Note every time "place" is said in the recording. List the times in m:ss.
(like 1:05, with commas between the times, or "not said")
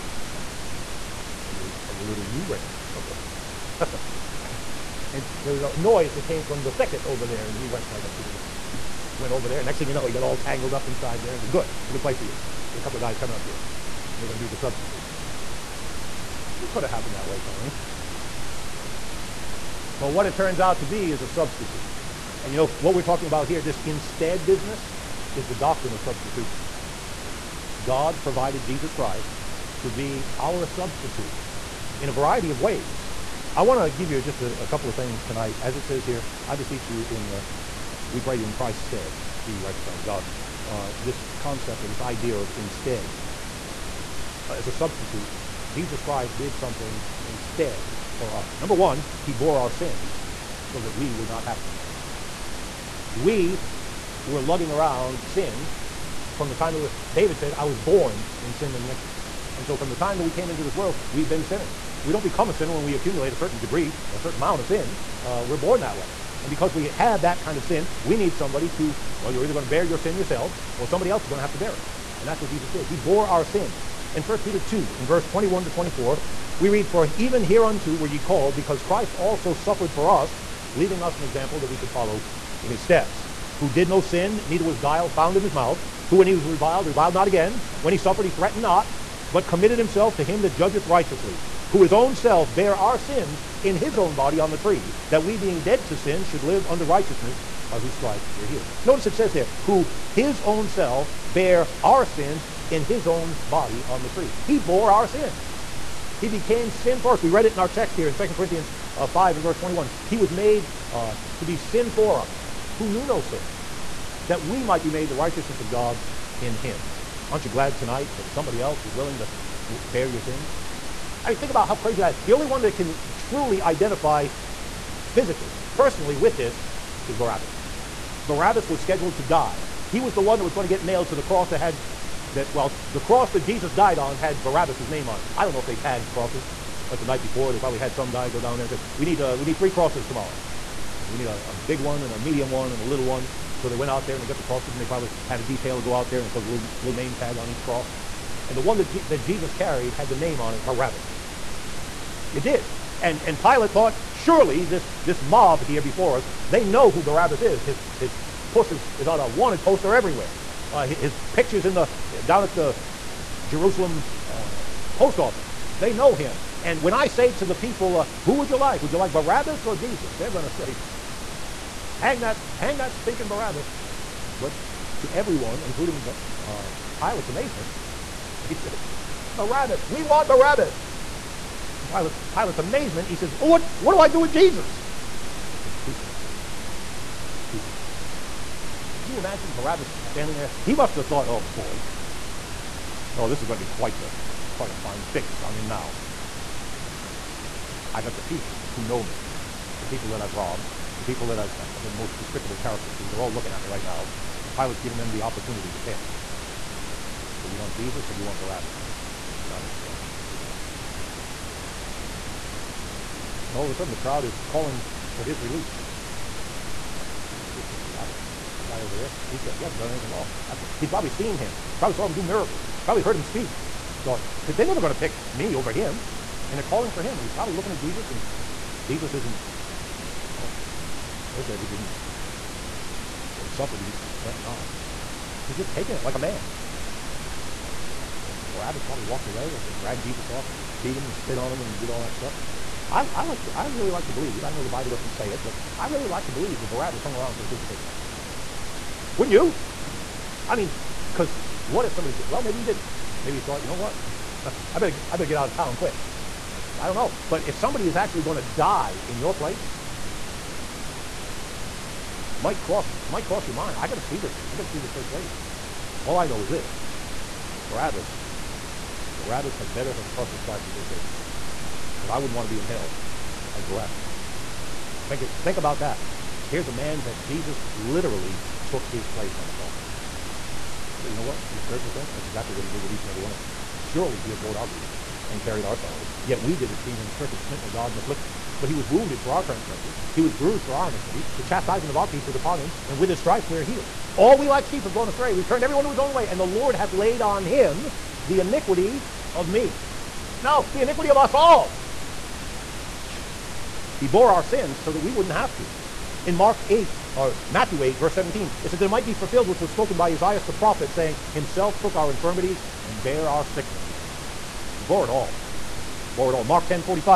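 0:12, 4:19, 4:25, 4:39.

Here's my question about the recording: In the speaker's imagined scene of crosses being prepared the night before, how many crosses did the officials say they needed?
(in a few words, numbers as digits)
3.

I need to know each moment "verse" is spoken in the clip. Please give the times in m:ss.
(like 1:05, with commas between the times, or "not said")
1:15, 1:49, 5:07.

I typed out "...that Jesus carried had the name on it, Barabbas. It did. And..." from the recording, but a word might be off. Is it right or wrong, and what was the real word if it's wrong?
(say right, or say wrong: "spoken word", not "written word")
right.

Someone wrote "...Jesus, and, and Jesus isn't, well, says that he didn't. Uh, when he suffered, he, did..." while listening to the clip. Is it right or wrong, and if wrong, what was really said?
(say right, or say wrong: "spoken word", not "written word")
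right.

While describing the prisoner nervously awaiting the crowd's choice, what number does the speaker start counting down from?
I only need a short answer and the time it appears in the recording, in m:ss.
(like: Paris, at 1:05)
10, at 3:30.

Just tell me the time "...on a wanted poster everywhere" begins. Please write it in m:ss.
2:39.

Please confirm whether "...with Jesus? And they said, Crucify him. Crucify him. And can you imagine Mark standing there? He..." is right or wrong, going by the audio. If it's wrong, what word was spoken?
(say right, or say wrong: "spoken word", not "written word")
wrong: "Barabbas", not "Mark".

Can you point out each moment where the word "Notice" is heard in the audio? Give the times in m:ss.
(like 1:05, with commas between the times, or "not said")
1:38.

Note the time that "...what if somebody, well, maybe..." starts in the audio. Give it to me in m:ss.
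4:11.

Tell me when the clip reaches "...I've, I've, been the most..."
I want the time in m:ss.
3:21.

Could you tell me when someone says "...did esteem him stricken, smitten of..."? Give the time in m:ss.
4:46.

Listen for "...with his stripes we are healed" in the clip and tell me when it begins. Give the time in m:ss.
4:52.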